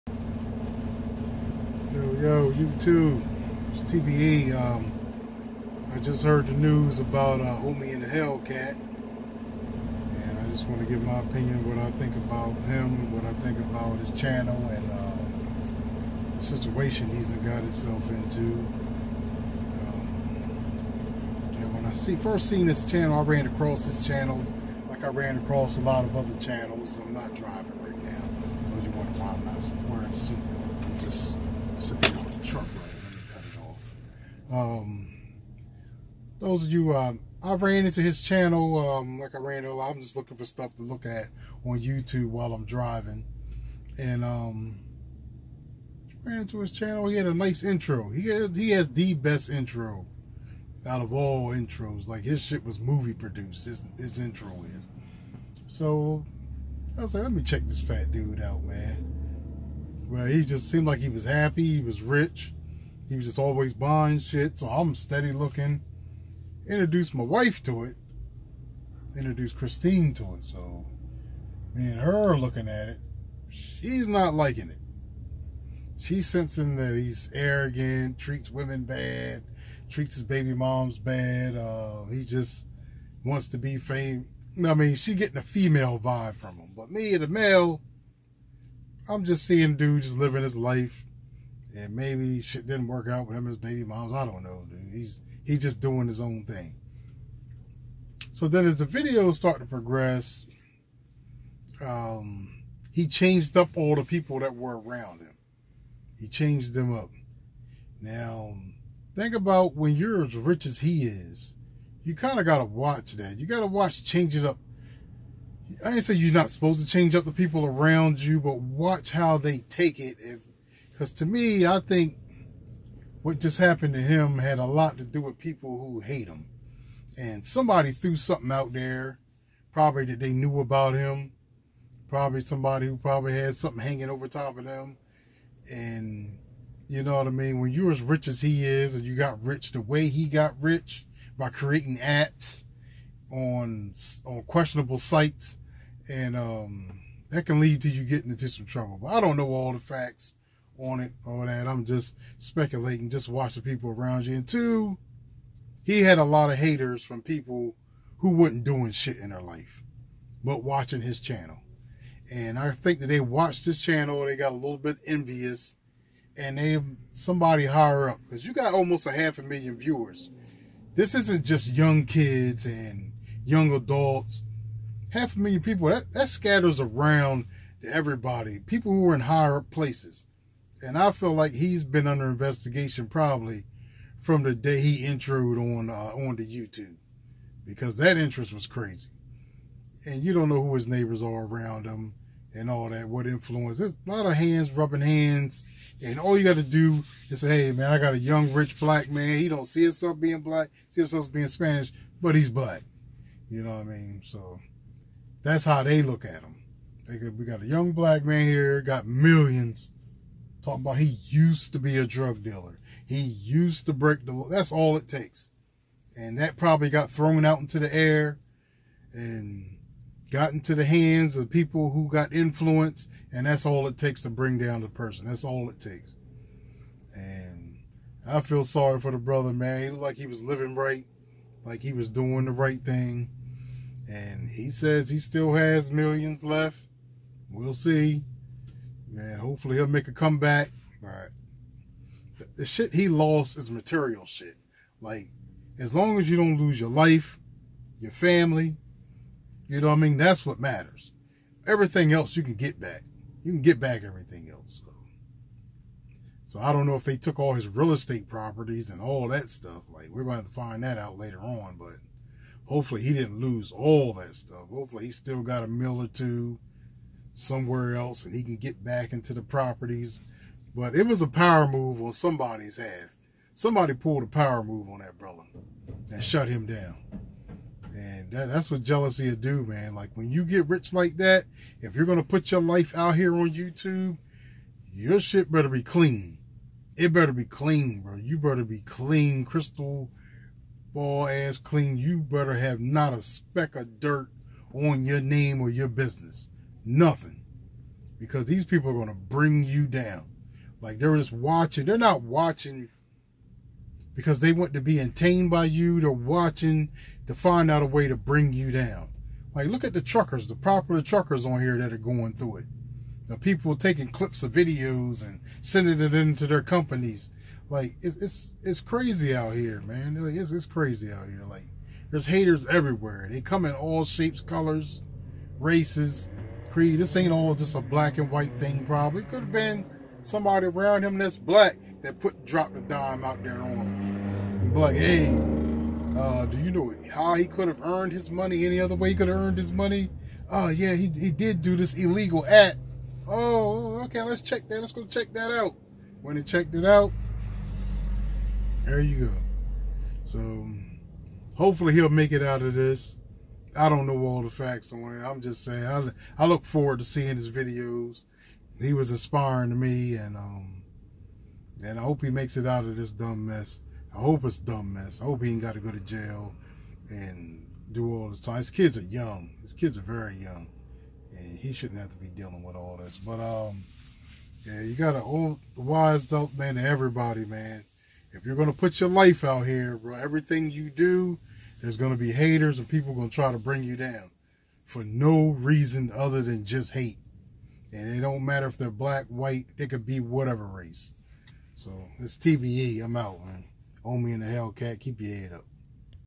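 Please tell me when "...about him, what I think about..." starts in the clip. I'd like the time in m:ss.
0:12.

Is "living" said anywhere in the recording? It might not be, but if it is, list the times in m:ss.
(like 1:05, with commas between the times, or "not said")
1:30, 3:50.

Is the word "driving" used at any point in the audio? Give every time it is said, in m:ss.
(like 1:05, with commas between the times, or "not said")
0:27, 0:42.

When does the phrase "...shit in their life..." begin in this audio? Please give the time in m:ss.
2:38.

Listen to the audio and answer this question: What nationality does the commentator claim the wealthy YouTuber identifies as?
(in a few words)
Spanish.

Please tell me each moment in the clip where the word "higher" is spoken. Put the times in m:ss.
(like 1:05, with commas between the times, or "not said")
2:47, 2:59.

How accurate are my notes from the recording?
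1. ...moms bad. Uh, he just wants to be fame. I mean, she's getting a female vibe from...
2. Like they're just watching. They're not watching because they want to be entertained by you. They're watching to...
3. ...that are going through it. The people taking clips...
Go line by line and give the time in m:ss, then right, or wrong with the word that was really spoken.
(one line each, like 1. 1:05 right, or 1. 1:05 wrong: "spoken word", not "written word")
1. 1:20 right
2. 5:00 right
3. 5:11 right.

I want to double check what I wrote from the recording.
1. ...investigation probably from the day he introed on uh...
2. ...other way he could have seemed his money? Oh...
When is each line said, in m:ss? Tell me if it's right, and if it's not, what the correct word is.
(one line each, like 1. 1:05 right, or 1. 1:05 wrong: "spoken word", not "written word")
1. 3:02 right
2. 5:38 wrong: "earned", not "seemed".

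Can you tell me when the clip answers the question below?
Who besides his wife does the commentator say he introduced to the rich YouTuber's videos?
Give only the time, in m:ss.
1:09.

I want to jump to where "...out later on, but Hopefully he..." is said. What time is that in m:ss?
4:20.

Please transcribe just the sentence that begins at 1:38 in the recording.
So then, as the videos start to progress, um, he changed up all the people that were around him.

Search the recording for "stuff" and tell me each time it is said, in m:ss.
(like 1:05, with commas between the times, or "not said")
0:40, 4:19, 4:24.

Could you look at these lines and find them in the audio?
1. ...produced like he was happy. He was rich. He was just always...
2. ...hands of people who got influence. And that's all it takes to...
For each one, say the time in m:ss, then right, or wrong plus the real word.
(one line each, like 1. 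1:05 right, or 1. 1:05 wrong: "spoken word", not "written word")
1. 1:00 wrong: "seemed", not "produced"
2. 3:40 right.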